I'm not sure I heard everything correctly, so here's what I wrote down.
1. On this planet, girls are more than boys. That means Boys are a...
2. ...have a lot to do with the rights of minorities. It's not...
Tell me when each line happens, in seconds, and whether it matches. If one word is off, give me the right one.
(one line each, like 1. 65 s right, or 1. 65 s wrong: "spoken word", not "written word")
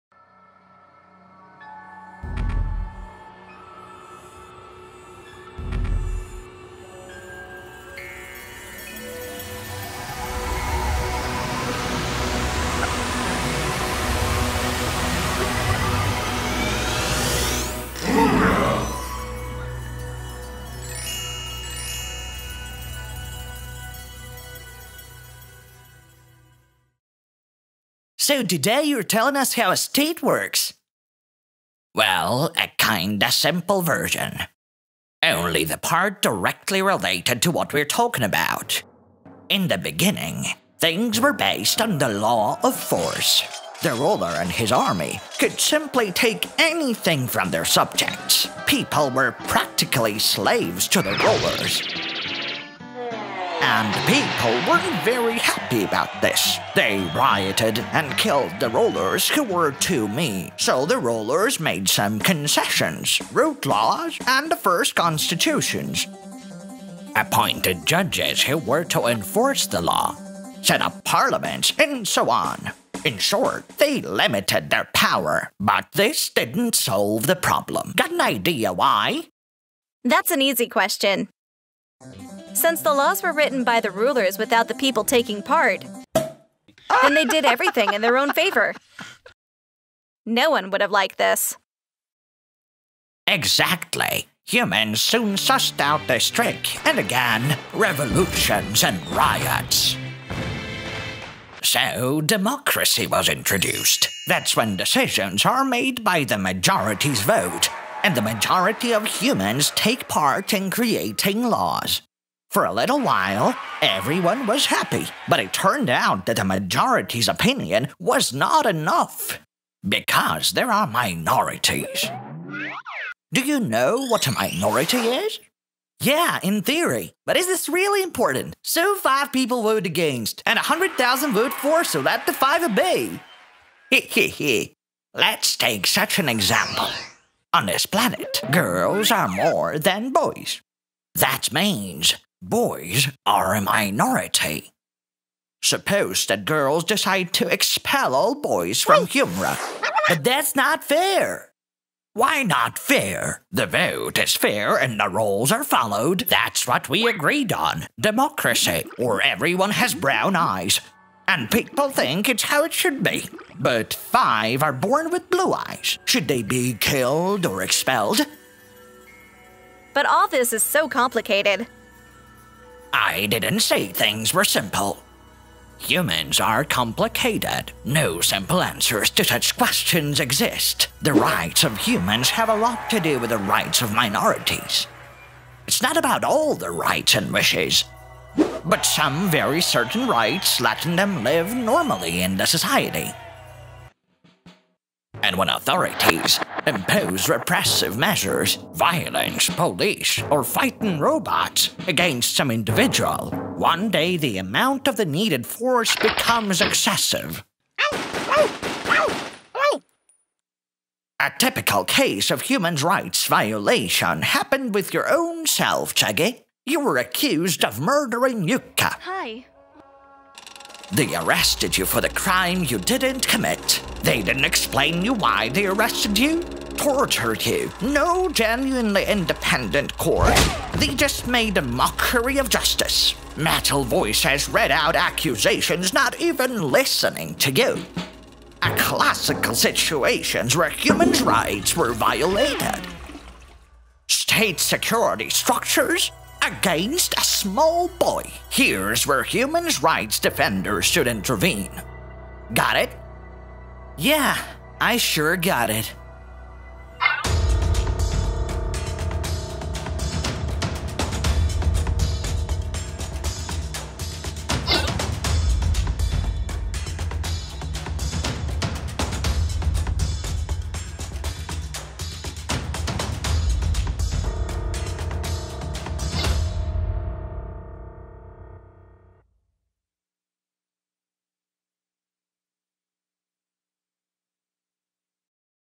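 1. 137 s right
2. 182 s right.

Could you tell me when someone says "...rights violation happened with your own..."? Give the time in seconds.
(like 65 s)
212 s.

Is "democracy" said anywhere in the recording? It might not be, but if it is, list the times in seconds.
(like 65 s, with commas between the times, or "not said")
102 s, 157 s.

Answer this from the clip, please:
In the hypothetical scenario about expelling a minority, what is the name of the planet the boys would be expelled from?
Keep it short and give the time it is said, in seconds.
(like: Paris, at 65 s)
Humra, at 149 s.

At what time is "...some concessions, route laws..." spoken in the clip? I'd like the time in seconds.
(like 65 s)
61 s.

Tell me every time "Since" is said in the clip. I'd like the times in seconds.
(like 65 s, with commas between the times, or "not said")
82 s.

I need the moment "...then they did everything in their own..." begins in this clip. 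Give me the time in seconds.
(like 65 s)
86 s.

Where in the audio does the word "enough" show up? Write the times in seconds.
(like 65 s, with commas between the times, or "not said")
118 s.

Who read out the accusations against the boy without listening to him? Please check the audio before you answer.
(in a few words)
Metal Voice.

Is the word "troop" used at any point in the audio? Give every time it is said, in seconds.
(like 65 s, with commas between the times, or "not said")
not said.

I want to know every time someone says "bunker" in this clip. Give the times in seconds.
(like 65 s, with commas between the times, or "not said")
not said.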